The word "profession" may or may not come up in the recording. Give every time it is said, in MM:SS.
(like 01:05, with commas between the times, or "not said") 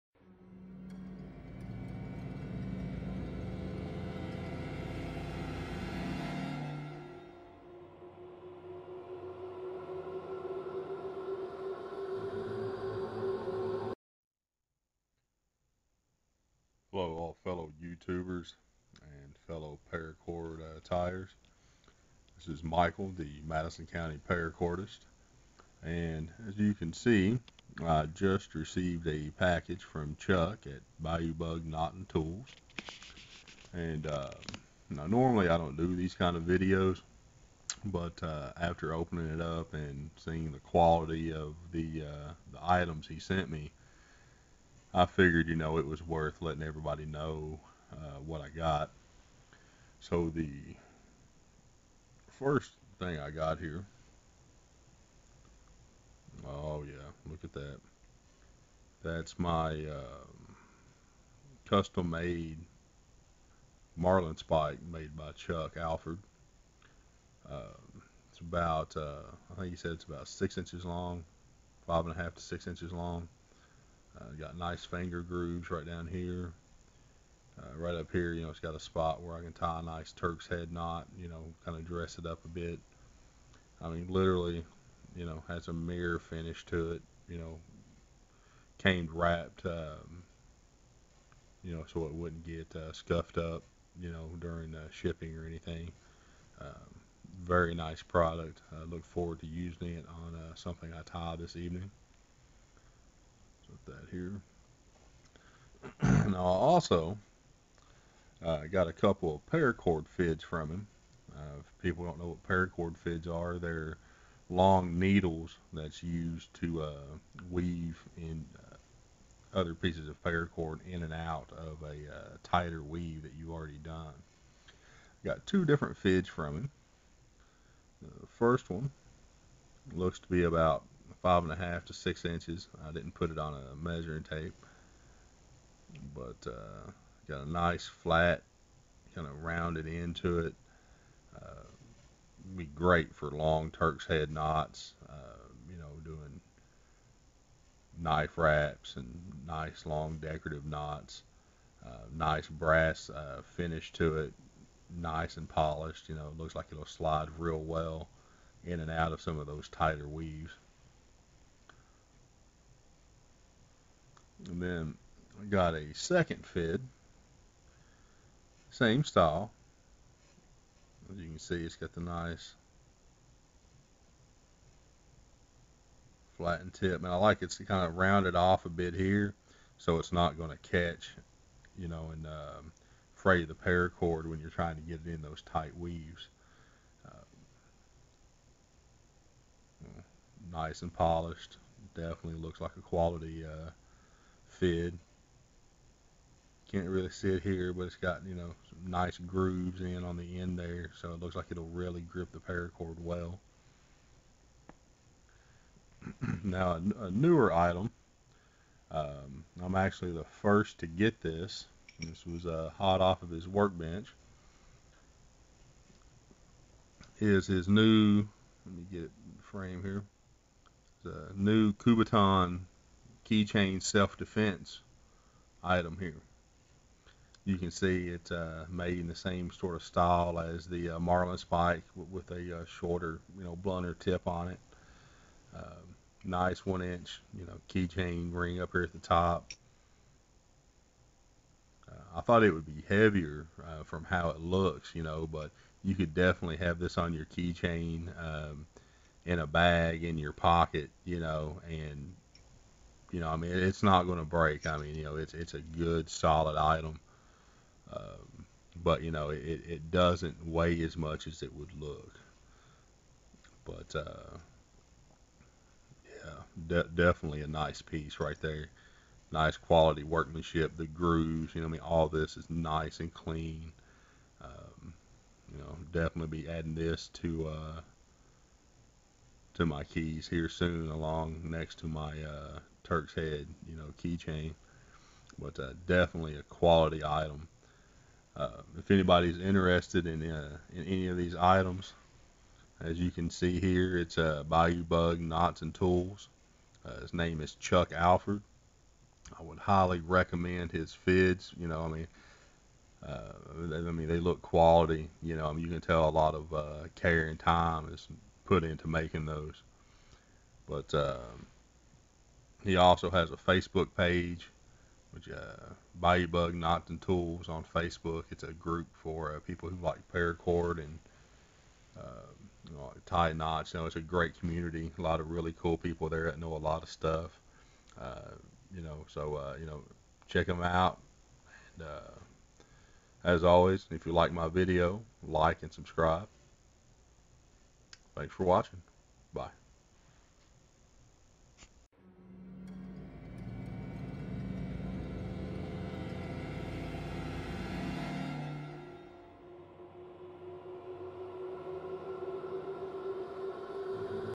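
not said.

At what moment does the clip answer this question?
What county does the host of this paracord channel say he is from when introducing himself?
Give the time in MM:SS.
00:23.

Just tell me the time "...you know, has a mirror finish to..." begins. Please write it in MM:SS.
01:25.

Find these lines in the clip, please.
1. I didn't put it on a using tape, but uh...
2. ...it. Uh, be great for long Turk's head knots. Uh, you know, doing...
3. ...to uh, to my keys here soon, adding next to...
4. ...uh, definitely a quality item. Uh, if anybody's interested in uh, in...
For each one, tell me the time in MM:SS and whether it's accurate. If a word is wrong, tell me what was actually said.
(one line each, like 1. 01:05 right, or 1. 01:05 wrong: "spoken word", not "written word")
1. 02:12 wrong: "measuring", not "using"
2. 02:20 right
3. 04:37 wrong: "along", not "adding"
4. 04:45 right.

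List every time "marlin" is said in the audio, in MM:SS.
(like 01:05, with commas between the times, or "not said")
01:03, 03:50.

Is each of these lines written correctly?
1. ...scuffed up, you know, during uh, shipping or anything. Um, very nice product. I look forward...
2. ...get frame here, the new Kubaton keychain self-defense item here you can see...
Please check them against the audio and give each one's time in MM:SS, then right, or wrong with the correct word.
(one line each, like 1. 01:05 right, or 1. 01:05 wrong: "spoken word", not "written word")
1. 01:32 right
2. 03:38 right.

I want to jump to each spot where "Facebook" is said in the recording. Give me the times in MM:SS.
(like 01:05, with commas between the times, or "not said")
05:13, 05:17.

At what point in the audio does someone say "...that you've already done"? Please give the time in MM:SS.
02:03.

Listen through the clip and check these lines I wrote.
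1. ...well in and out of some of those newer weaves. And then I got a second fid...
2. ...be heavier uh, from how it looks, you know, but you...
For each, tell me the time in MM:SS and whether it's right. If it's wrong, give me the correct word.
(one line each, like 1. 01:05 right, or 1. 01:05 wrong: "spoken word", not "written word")
1. 02:37 wrong: "tighter", not "newer"
2. 04:02 right.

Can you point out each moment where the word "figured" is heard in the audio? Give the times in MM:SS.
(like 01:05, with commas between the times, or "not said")
00:45.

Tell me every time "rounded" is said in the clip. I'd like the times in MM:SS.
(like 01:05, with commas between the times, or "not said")
02:19, 02:57.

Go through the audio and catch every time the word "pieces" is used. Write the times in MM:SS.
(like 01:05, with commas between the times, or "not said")
01:59, 04:27.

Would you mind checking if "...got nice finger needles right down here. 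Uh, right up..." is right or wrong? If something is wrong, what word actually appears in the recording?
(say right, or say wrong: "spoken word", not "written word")
wrong: "grooves", not "needles".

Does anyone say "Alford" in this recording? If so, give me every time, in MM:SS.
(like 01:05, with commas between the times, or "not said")
01:05, 04:57.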